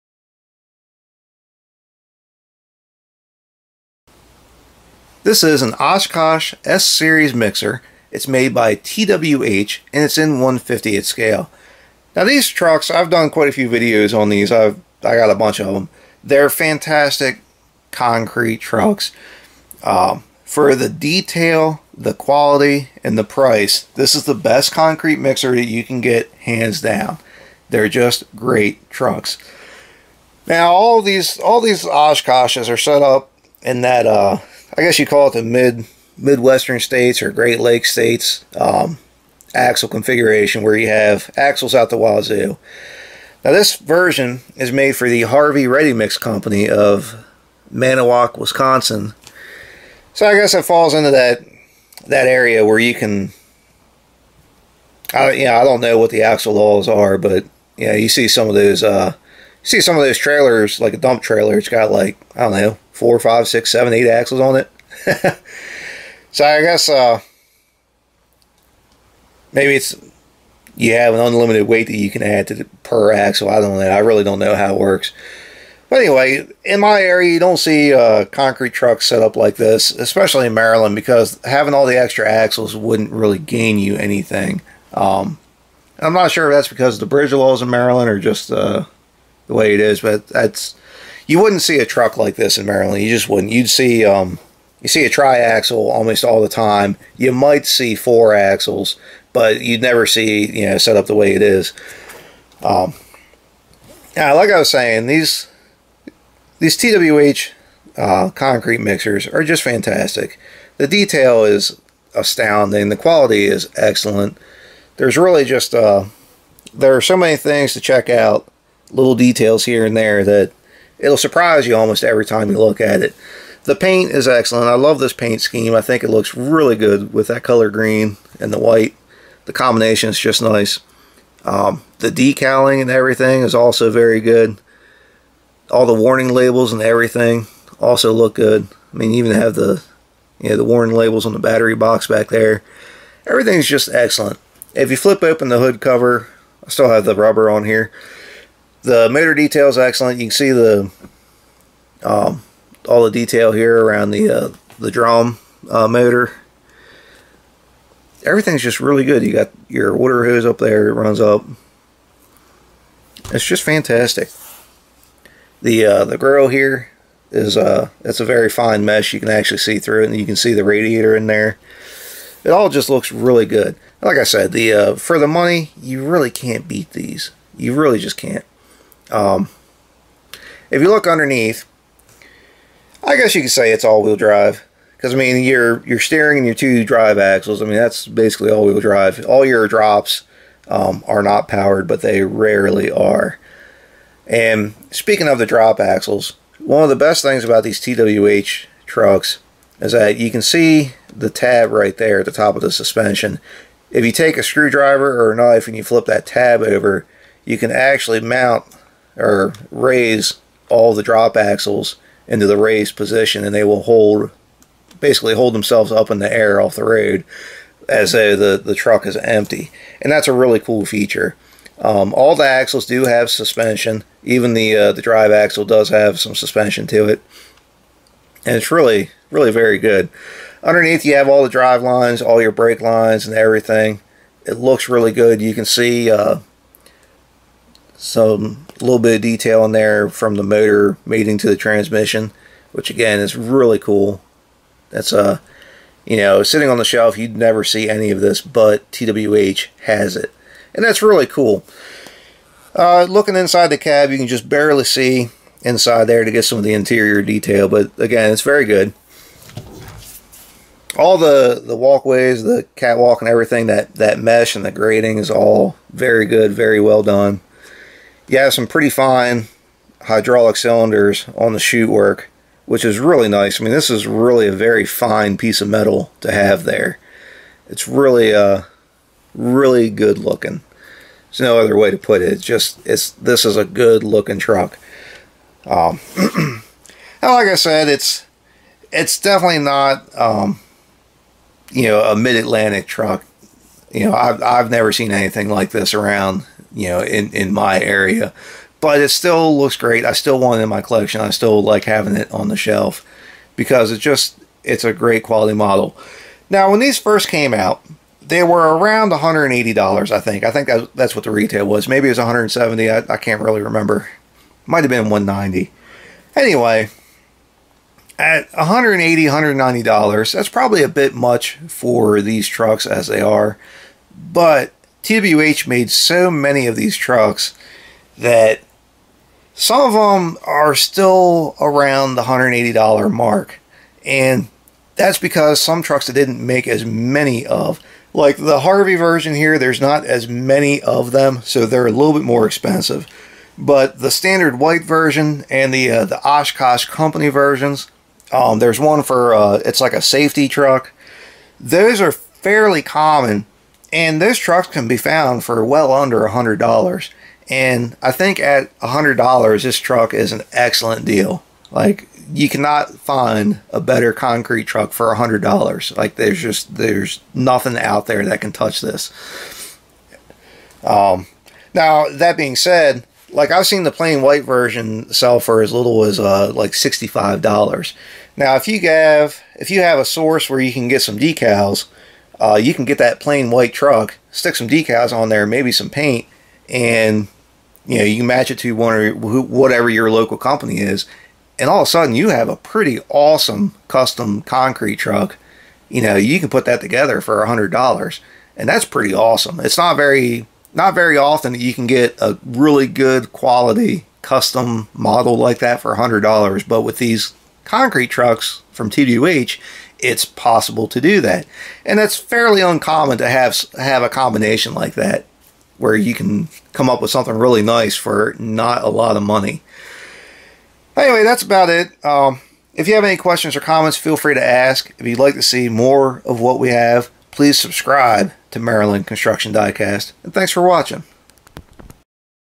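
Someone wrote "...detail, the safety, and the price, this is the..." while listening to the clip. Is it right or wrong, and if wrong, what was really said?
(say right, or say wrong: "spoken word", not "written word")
wrong: "quality", not "safety".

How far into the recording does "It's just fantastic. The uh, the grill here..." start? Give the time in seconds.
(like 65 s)
163 s.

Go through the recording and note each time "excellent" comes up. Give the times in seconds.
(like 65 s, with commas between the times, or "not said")
113 s, 124 s, 143 s, 149 s, 360 s.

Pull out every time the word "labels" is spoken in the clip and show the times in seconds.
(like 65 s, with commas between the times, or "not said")
136 s, 140 s.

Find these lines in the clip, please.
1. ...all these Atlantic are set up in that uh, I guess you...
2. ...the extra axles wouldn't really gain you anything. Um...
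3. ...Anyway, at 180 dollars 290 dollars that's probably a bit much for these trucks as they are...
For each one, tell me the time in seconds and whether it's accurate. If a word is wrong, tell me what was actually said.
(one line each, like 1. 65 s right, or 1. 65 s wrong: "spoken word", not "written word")
1. 31 s wrong: "Oshkoshes", not "Atlantic"
2. 81 s right
3. 316 s wrong: "190", not "290".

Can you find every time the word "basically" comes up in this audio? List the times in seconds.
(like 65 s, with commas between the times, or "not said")
188 s, 214 s.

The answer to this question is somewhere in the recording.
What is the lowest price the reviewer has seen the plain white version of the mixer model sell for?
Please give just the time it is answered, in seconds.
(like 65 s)
376 s.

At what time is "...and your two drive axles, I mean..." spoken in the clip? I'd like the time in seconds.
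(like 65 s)
186 s.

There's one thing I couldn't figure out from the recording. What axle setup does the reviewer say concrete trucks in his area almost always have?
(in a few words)
Triaxle.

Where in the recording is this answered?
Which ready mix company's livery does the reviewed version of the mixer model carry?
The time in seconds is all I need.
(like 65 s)
45 s.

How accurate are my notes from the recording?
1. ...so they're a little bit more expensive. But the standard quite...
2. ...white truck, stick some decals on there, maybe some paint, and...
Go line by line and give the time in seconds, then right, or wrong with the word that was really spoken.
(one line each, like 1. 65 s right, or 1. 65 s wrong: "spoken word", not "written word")
1. 341 s wrong: "white", not "quite"
2. 383 s right.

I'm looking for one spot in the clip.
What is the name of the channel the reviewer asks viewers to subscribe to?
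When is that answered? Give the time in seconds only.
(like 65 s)
428 s.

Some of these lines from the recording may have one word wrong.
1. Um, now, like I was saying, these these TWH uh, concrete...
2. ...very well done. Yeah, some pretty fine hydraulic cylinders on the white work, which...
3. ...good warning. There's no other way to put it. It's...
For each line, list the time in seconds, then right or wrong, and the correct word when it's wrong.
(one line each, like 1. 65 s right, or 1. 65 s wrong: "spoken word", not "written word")
1. 102 s right
2. 266 s wrong: "chute", not "white"
3. 279 s wrong: "looking", not "warning".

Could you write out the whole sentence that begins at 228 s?
And it's really, really very good.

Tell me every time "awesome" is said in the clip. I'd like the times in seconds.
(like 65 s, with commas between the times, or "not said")
393 s, 399 s.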